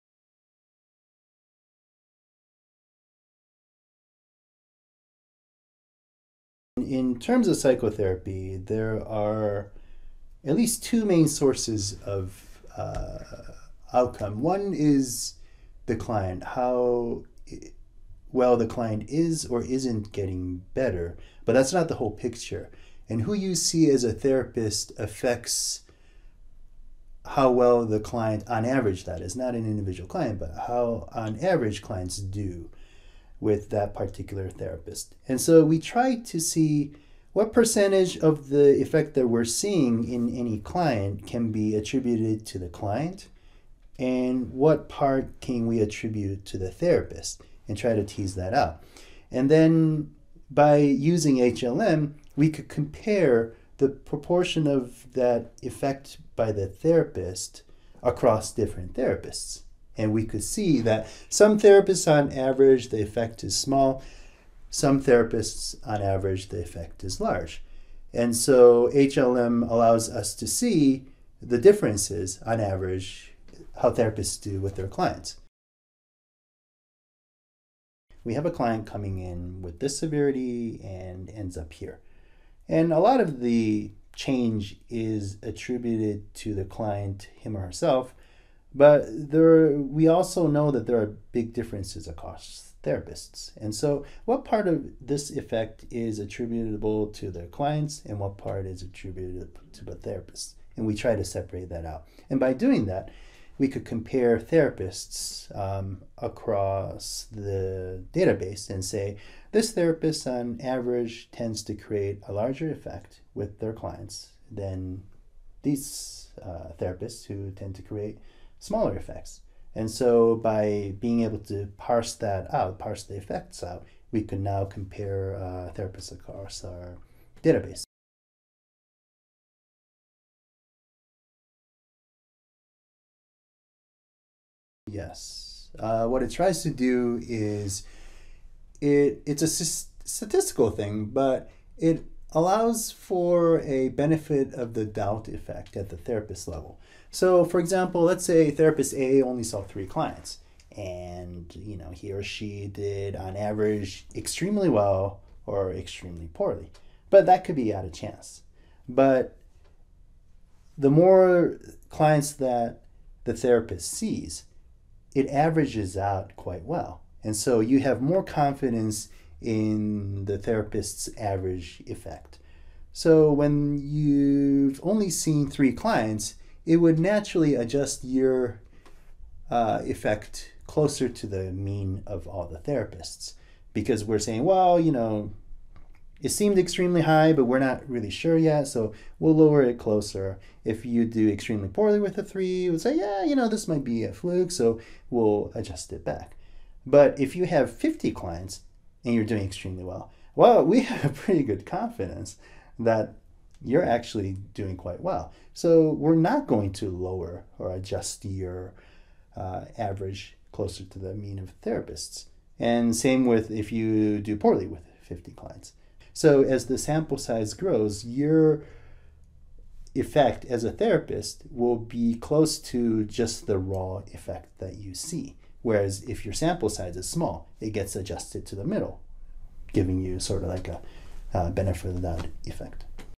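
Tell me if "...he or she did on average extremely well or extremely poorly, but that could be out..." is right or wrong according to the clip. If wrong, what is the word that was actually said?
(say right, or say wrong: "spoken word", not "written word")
right.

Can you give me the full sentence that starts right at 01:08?
And so HLM allows us to see the differences on average how therapists do with their clients.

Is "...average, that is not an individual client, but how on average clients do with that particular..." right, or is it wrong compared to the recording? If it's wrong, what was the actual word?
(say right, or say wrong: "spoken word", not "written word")
right.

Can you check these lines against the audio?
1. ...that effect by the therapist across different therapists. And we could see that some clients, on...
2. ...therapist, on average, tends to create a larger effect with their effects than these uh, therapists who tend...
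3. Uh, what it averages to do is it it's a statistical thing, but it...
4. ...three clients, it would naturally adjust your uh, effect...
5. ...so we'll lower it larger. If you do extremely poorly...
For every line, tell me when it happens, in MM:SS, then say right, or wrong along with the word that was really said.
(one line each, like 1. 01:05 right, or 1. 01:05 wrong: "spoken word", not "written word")
1. 00:55 wrong: "therapists", not "clients"
2. 01:49 wrong: "clients", not "effects"
3. 02:15 wrong: "tries", not "averages"
4. 02:55 right
5. 03:08 wrong: "closer", not "larger".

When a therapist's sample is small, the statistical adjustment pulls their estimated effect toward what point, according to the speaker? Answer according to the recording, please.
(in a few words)
the middle.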